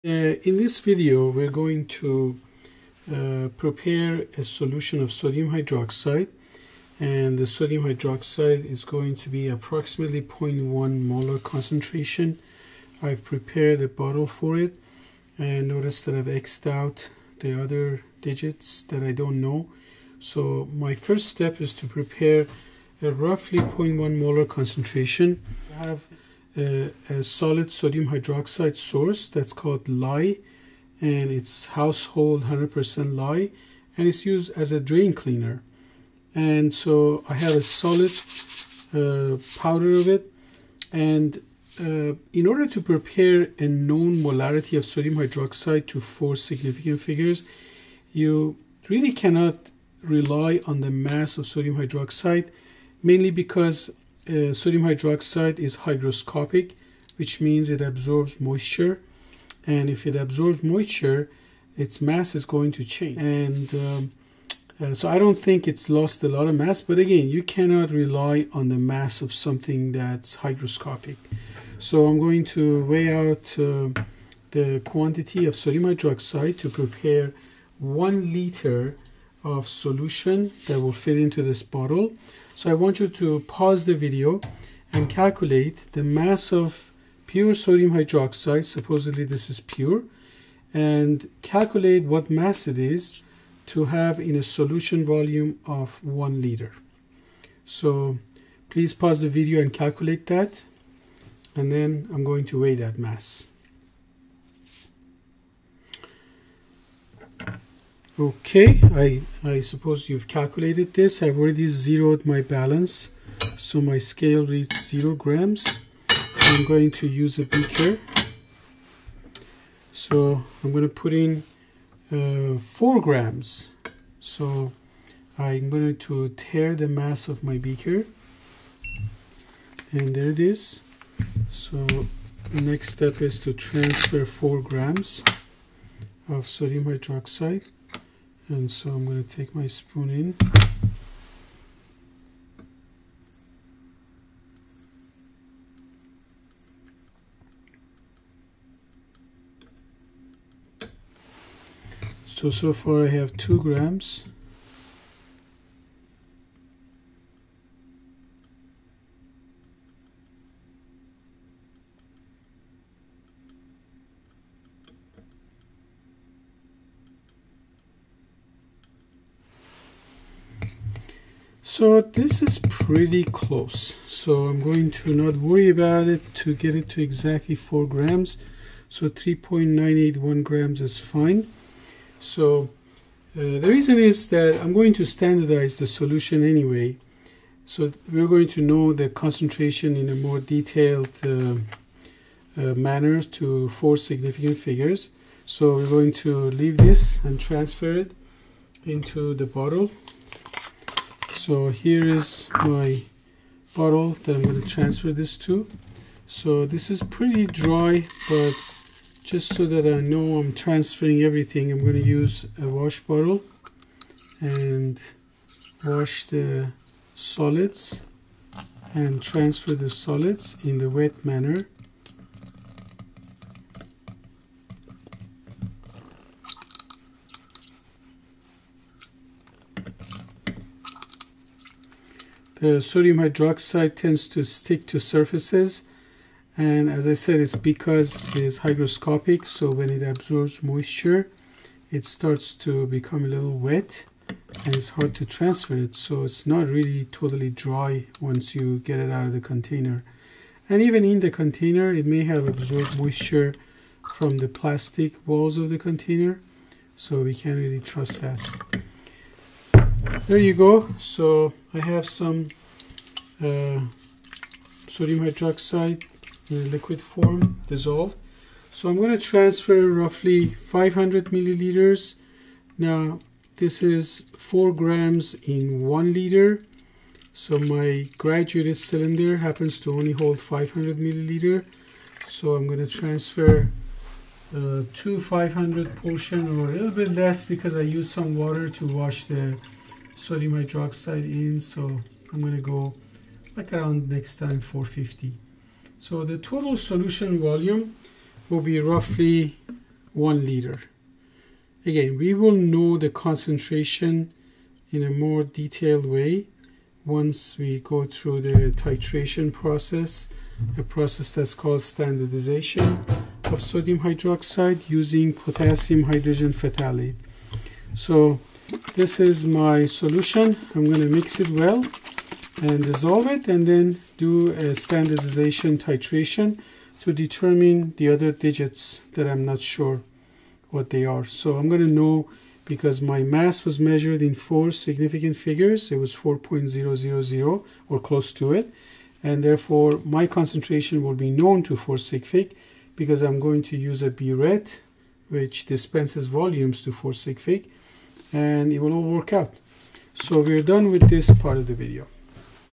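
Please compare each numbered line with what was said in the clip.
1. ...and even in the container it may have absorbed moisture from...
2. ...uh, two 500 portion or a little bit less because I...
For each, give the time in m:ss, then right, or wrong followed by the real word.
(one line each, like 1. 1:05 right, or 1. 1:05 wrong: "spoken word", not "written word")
1. 4:10 right
2. 4:44 right.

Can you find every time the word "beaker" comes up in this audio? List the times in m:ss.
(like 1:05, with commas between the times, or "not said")
1:57, 2:07.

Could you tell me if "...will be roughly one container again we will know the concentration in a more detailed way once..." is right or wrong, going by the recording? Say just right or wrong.
wrong.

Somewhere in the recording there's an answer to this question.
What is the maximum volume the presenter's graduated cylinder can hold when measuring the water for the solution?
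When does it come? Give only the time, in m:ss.
4:40.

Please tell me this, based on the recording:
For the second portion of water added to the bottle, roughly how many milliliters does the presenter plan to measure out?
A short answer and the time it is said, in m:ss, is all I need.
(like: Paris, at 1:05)
450, at 4:54.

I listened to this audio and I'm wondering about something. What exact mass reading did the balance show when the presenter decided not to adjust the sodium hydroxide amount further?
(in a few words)
3.981 grams.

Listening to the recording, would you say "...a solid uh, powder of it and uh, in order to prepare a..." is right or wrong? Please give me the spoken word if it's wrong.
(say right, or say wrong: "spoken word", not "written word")
right.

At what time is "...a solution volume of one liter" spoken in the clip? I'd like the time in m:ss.
1:34.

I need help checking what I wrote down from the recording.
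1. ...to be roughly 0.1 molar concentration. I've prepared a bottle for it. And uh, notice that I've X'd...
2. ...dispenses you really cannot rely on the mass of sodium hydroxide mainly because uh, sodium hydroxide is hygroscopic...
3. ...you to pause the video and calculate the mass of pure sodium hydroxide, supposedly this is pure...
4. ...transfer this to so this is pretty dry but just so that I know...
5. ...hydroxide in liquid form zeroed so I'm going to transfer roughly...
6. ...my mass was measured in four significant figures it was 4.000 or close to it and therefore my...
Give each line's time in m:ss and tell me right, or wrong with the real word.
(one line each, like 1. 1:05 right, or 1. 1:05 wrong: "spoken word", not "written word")
1. 0:09 wrong: "approximately", not "roughly"
2. 0:46 wrong: "figures", not "dispenses"
3. 1:22 right
4. 3:24 right
5. 4:25 wrong: "dissolved", not "zeroed"
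6. 5:33 right.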